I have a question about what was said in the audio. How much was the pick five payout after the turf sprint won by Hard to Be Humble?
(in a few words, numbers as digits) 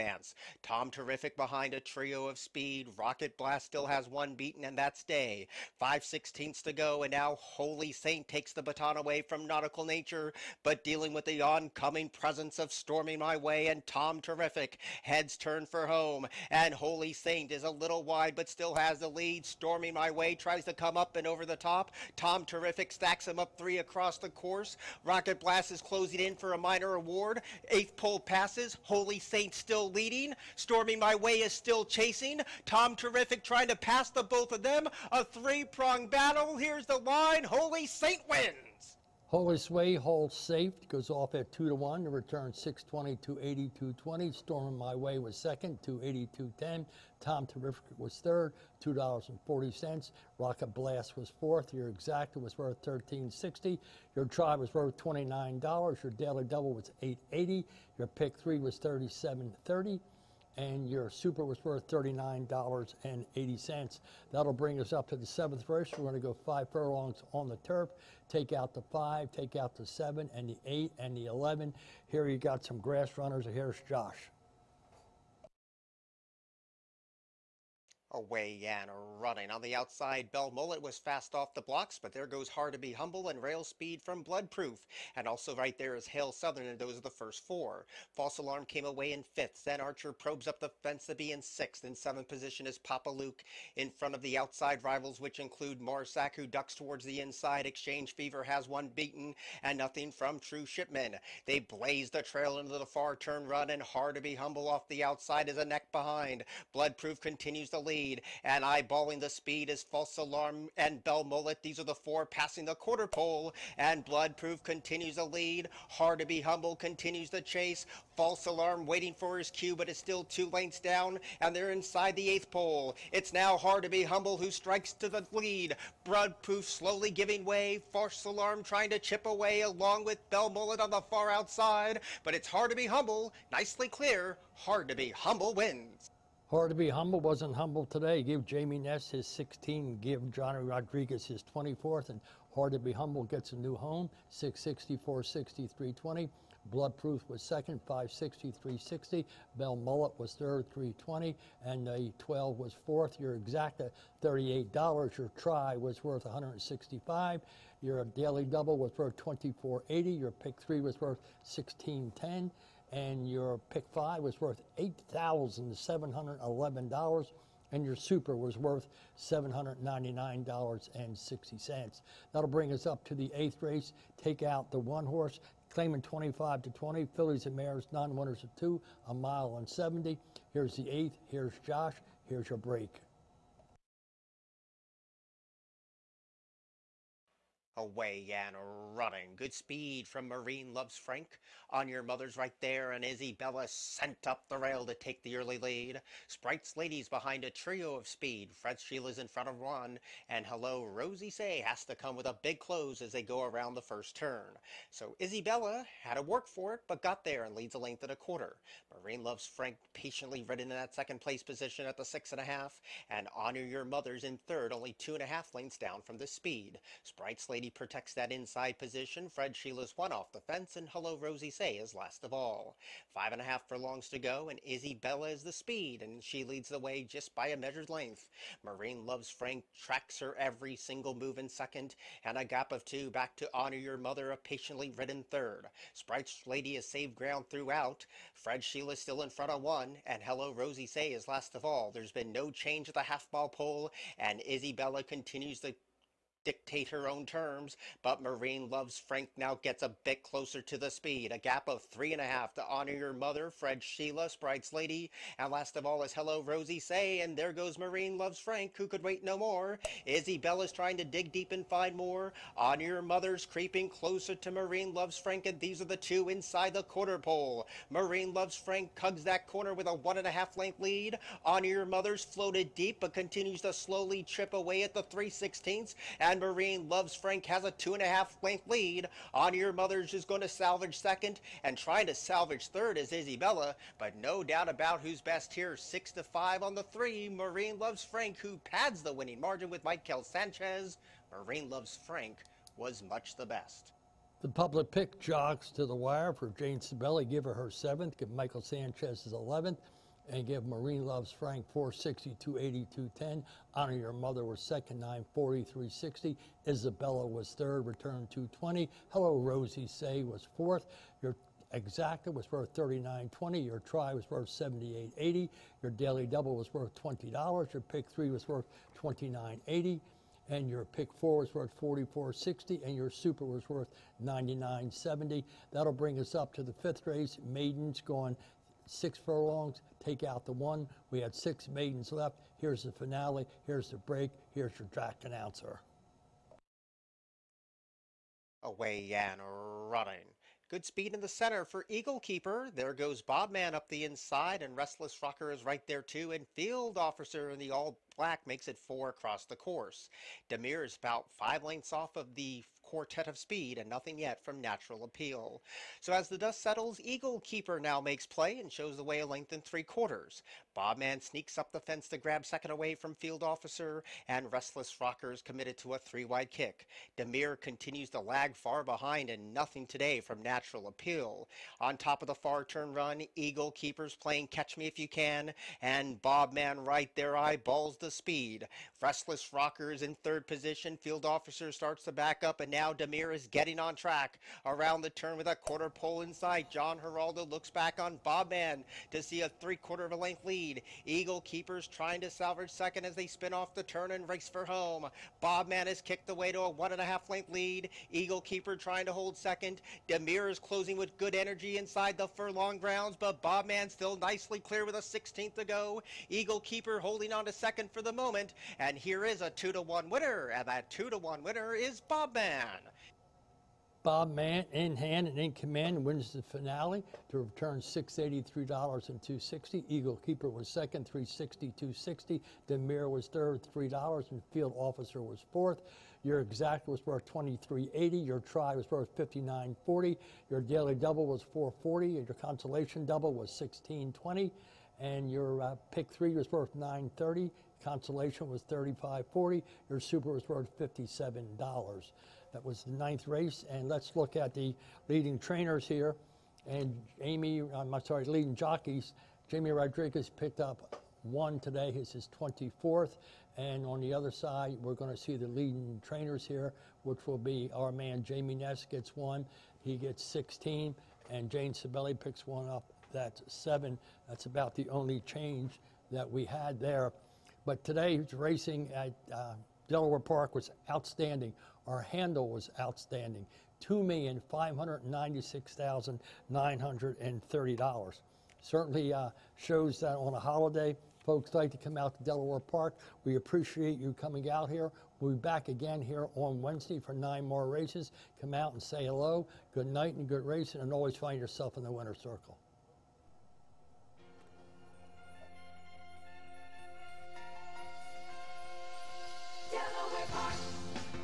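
$8,711.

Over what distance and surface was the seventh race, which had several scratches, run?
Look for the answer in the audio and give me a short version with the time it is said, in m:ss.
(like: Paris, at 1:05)
Five furlongs on the turf, at 1:06.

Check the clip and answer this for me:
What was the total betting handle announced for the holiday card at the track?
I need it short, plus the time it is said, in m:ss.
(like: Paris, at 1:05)
$2,596,930, at 7:53.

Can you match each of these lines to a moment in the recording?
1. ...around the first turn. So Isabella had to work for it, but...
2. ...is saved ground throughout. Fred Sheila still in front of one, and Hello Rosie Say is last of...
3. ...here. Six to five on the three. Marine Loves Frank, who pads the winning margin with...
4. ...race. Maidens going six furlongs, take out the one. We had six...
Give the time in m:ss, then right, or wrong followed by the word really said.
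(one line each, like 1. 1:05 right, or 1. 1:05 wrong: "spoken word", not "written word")
1. 3:23 right
2. 3:56 right
3. 4:45 right
4. 5:27 right.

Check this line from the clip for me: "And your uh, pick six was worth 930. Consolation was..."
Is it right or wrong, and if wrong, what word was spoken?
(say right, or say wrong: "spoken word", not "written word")
wrong: "three", not "six".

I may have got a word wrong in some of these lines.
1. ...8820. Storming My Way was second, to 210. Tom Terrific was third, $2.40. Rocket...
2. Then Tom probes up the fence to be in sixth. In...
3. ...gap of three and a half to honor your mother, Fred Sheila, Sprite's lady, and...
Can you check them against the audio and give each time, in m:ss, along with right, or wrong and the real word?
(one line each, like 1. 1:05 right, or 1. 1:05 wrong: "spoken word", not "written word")
1. 0:43 wrong: "8220", not "8820"
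2. 1:29 wrong: "Archer", not "Tom"
3. 4:11 right.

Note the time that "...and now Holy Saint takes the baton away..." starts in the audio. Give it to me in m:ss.
0:07.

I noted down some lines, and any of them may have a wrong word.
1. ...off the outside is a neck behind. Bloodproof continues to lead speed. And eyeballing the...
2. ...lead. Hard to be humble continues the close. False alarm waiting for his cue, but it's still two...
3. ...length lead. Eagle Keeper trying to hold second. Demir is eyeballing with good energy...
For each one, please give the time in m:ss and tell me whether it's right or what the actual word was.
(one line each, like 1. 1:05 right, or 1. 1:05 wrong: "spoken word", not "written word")
1. 1:44 right
2. 1:55 wrong: "chase", not "close"
3. 6:37 wrong: "closing", not "eyeballing".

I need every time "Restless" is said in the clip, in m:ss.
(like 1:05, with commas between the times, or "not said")
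5:44, 6:04, 6:19.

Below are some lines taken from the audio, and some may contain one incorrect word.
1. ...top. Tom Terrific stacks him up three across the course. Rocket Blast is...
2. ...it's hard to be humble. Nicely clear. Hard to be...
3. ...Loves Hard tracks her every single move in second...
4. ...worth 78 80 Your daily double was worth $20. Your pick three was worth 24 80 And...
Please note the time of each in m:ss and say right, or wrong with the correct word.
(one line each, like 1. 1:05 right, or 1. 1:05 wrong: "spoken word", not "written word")
1. 0:21 right
2. 2:12 right
3. 3:49 wrong: "Frank", not "Hard"
4. 5:14 wrong: "29", not "24".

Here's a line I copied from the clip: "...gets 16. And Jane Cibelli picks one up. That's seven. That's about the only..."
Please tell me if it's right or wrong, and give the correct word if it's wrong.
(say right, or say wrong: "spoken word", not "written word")
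right.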